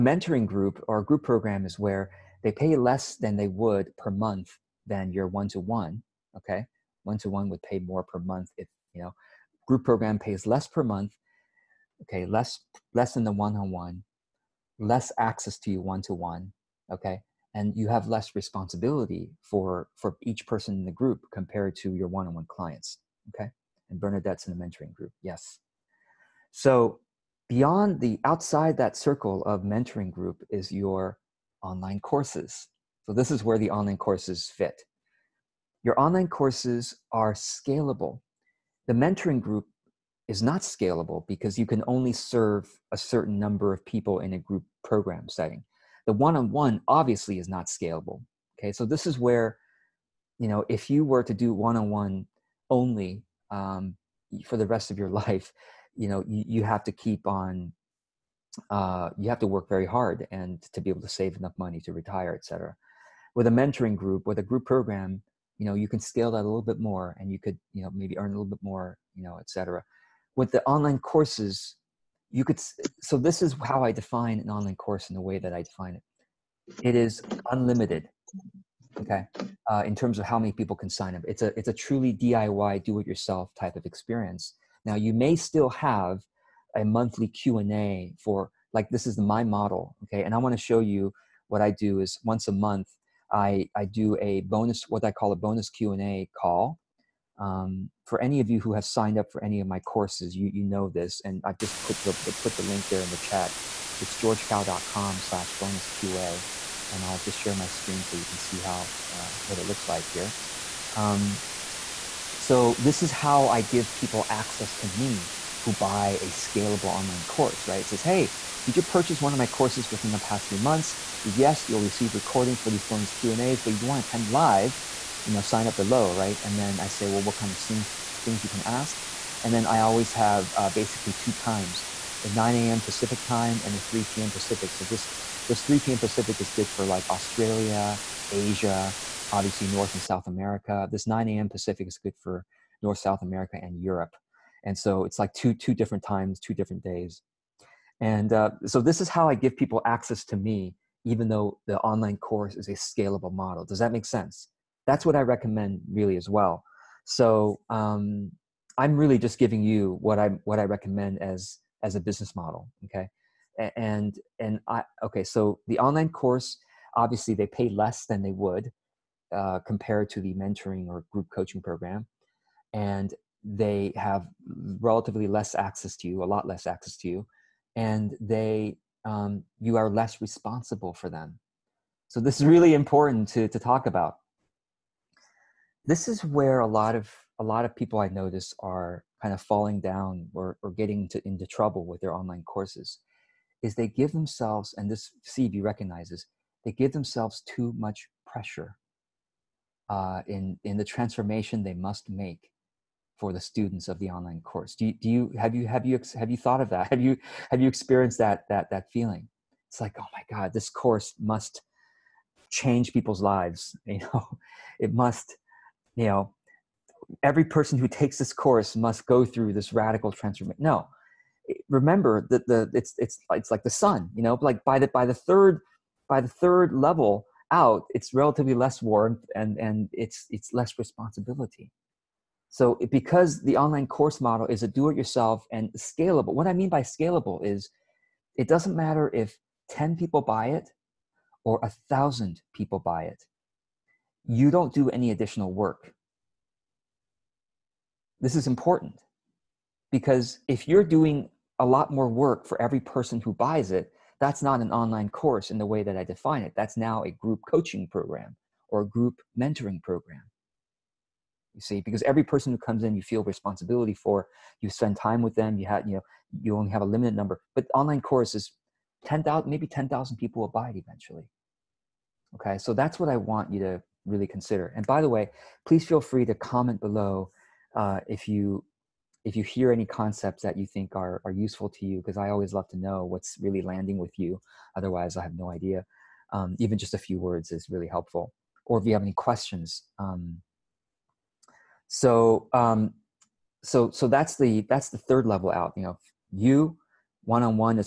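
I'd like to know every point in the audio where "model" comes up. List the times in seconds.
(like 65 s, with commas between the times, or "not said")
89 s, 153 s, 162 s, 234 s.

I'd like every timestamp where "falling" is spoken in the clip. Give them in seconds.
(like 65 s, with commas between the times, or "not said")
189 s.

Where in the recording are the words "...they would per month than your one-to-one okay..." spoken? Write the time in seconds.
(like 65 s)
3 s.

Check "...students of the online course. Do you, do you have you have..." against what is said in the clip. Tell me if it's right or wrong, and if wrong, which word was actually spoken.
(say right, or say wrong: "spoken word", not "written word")
right.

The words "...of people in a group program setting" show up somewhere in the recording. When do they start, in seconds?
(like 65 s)
43 s.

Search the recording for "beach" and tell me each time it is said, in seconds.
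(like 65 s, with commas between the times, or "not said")
not said.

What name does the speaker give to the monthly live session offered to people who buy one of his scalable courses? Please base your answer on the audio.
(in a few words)
Bonus Q&A call.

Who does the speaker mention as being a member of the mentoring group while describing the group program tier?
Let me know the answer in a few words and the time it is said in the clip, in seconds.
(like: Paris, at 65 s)
Bernadette, at 24 s.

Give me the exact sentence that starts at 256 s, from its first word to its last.
That's now a group coaching program or a group mentoring program.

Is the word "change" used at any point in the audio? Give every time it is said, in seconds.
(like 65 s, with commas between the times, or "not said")
212 s.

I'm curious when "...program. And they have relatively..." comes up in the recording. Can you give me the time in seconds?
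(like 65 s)
171 s.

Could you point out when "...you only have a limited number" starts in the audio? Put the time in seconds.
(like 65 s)
266 s.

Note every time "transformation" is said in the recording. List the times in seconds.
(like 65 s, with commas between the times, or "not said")
200 s, 220 s.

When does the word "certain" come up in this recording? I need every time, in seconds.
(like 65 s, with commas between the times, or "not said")
42 s.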